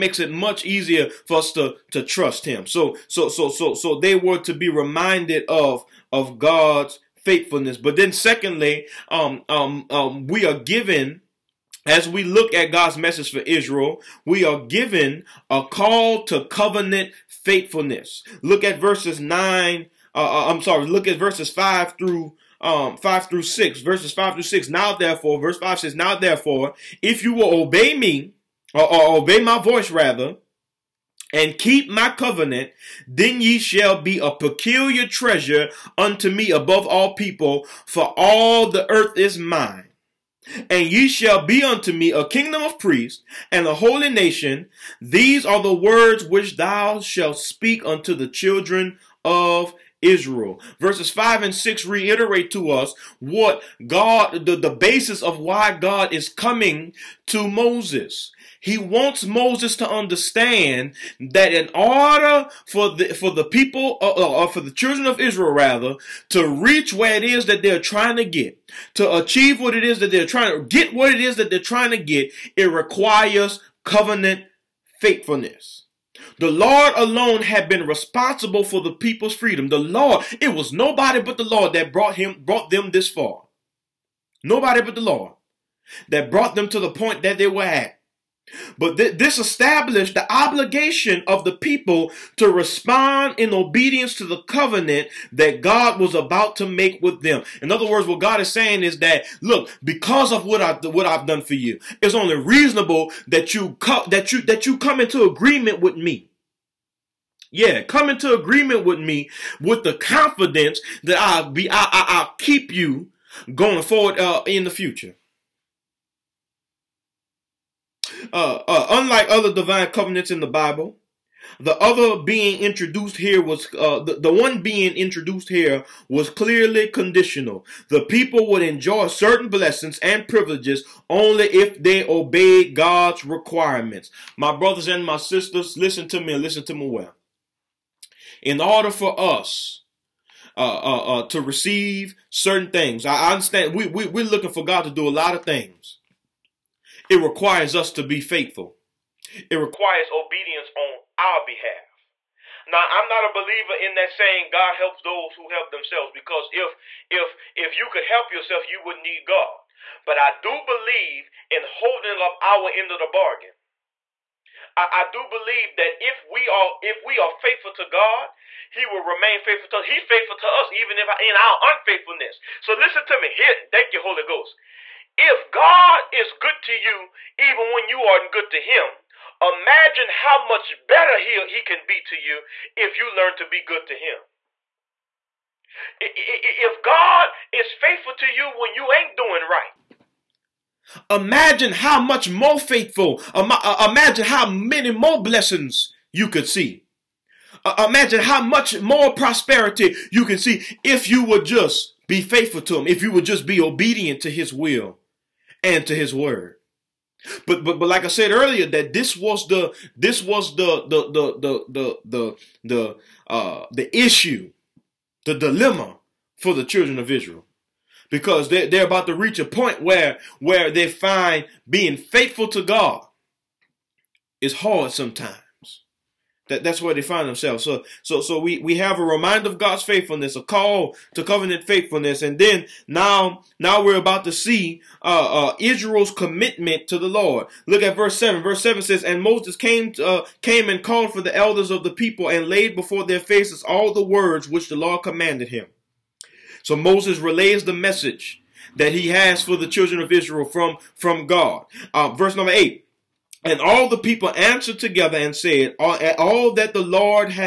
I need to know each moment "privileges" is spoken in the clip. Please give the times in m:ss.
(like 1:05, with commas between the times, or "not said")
2:10.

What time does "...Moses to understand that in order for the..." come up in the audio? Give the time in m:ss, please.
0:59.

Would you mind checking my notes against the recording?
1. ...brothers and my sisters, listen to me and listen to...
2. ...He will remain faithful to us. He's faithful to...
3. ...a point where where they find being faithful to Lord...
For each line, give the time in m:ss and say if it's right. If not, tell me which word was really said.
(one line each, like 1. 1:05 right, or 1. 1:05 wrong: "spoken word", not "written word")
1. 2:14 right
2. 2:48 right
3. 3:39 wrong: "God", not "Lord".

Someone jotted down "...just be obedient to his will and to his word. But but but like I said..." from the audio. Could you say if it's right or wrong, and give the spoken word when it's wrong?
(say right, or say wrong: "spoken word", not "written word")
right.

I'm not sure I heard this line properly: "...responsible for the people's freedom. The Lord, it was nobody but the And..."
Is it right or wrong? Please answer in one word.
wrong.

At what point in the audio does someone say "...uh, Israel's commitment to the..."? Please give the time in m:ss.
3:55.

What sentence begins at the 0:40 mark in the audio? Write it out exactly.
And ye shall be unto me a kingdom of priests and a holy nation.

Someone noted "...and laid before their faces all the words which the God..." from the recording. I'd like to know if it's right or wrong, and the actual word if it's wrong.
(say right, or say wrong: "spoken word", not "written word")
wrong: "Lord", not "God".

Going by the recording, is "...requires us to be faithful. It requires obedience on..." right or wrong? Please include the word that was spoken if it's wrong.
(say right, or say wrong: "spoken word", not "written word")
right.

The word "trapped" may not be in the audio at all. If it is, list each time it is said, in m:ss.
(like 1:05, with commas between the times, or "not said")
not said.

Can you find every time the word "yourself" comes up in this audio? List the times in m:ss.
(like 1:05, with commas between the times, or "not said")
2:38.